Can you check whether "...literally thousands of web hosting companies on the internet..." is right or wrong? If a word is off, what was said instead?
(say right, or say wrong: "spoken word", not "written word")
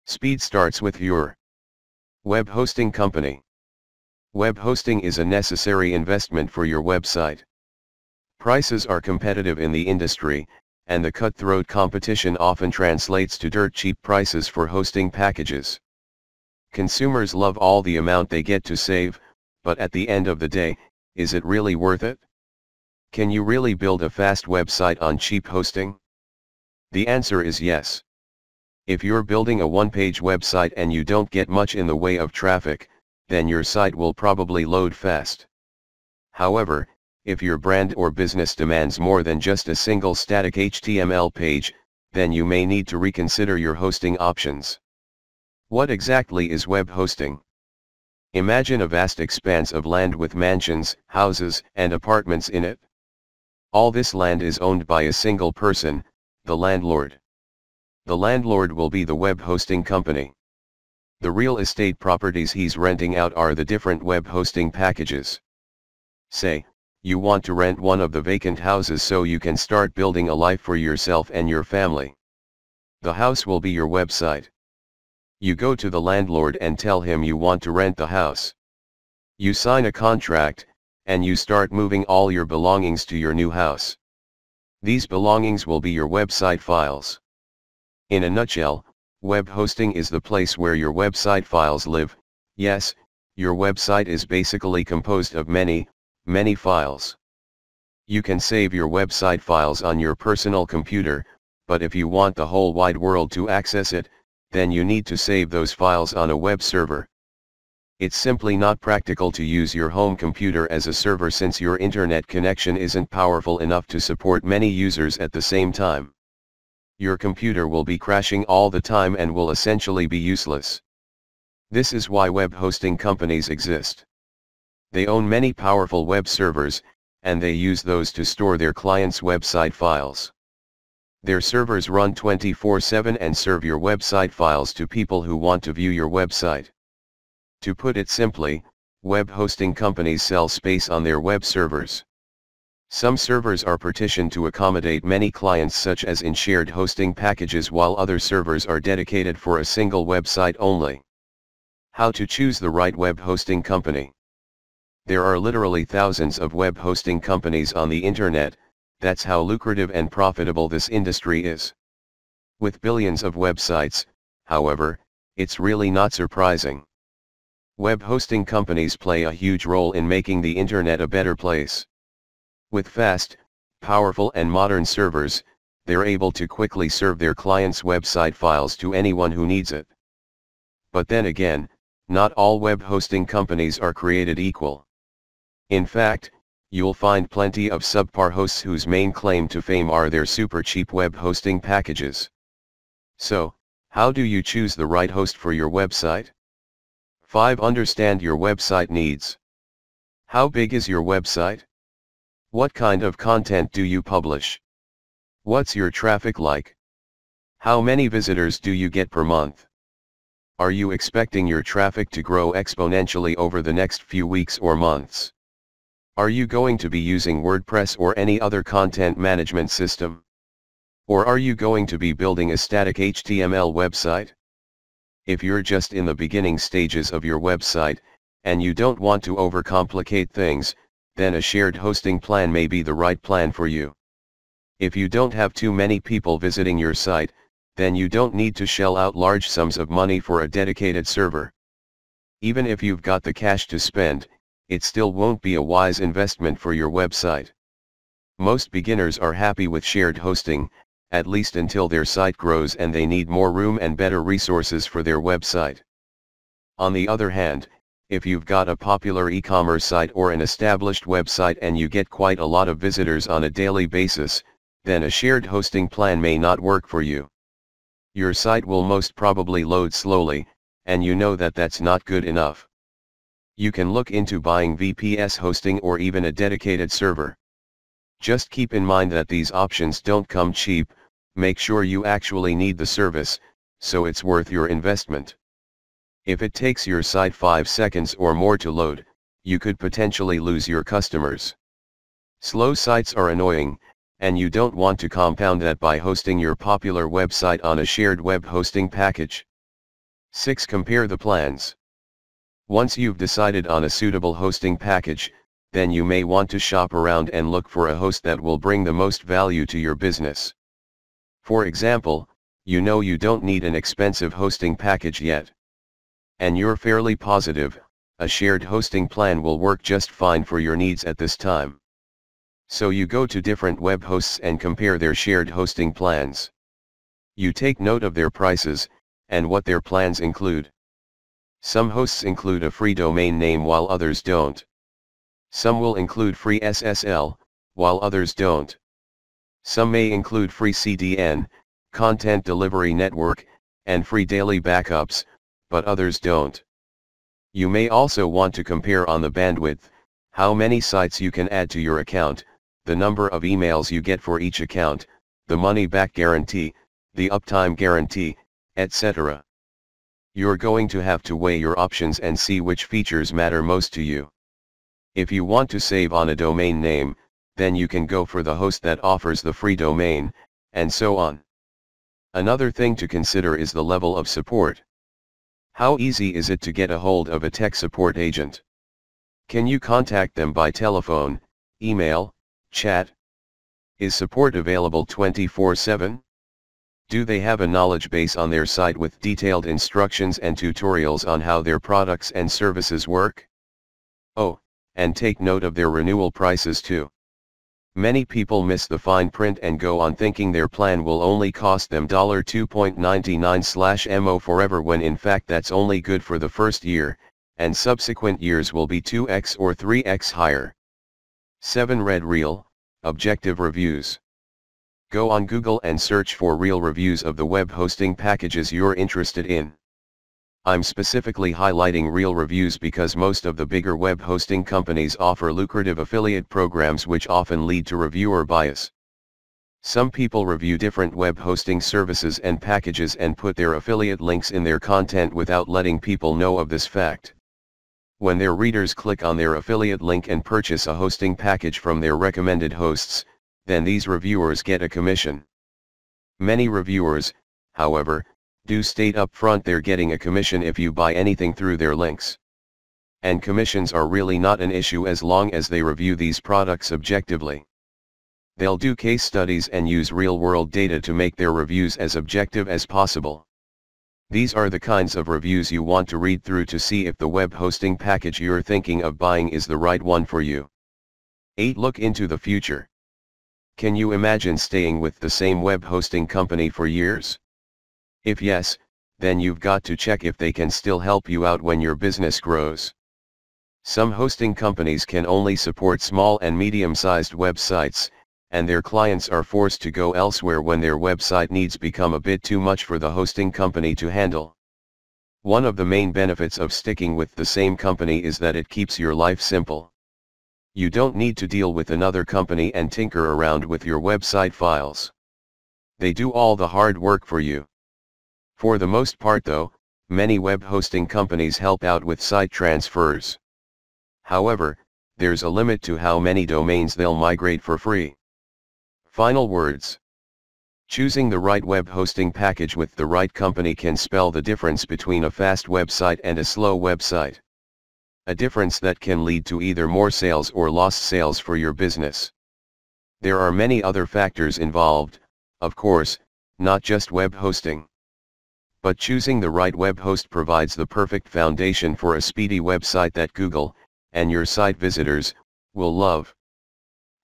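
right.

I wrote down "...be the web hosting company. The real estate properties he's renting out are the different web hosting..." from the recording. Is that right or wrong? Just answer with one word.
right.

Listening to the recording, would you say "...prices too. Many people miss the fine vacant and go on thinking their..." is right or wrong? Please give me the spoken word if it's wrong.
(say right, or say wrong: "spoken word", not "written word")
wrong: "print", not "vacant".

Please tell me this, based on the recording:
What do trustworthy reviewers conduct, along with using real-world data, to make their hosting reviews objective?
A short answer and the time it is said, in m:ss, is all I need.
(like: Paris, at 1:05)
Case studies, at 7:38.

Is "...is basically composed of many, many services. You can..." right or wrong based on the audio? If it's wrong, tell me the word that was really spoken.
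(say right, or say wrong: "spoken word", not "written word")
wrong: "files", not "services".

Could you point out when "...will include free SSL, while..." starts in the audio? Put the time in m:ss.
5:35.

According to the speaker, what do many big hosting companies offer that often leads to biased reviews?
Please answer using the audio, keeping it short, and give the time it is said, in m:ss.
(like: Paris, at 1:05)
Affiliate programs, at 7:05.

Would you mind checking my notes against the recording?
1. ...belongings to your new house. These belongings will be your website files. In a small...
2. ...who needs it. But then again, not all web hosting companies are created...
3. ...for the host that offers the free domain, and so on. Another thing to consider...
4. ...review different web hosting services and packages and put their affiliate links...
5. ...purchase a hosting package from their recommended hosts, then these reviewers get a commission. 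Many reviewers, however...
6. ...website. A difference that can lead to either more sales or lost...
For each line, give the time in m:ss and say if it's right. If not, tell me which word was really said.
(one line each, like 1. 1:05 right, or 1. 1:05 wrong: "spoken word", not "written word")
1. 1:22 wrong: "nutshell", not "small"
2. 2:59 right
3. 6:08 right
4. 7:10 right
5. 7:20 right
6. 8:46 right.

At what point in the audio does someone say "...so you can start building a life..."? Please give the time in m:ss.
1:09.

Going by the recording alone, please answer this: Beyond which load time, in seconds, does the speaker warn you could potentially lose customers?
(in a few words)
5 seconds.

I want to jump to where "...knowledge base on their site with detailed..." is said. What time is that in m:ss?
6:27.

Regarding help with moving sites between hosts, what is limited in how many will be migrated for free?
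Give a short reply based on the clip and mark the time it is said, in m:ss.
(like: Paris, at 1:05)
Domains, at 8:36.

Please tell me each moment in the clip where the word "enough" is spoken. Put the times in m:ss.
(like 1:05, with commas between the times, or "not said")
1:53, 4:32.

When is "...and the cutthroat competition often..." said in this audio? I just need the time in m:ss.
0:10.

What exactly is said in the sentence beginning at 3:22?
What kind of content do you publish?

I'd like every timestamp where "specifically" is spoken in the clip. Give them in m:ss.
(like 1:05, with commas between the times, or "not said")
7:00.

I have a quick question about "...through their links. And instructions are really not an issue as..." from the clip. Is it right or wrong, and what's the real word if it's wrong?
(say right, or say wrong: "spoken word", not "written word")
wrong: "commissions", not "instructions".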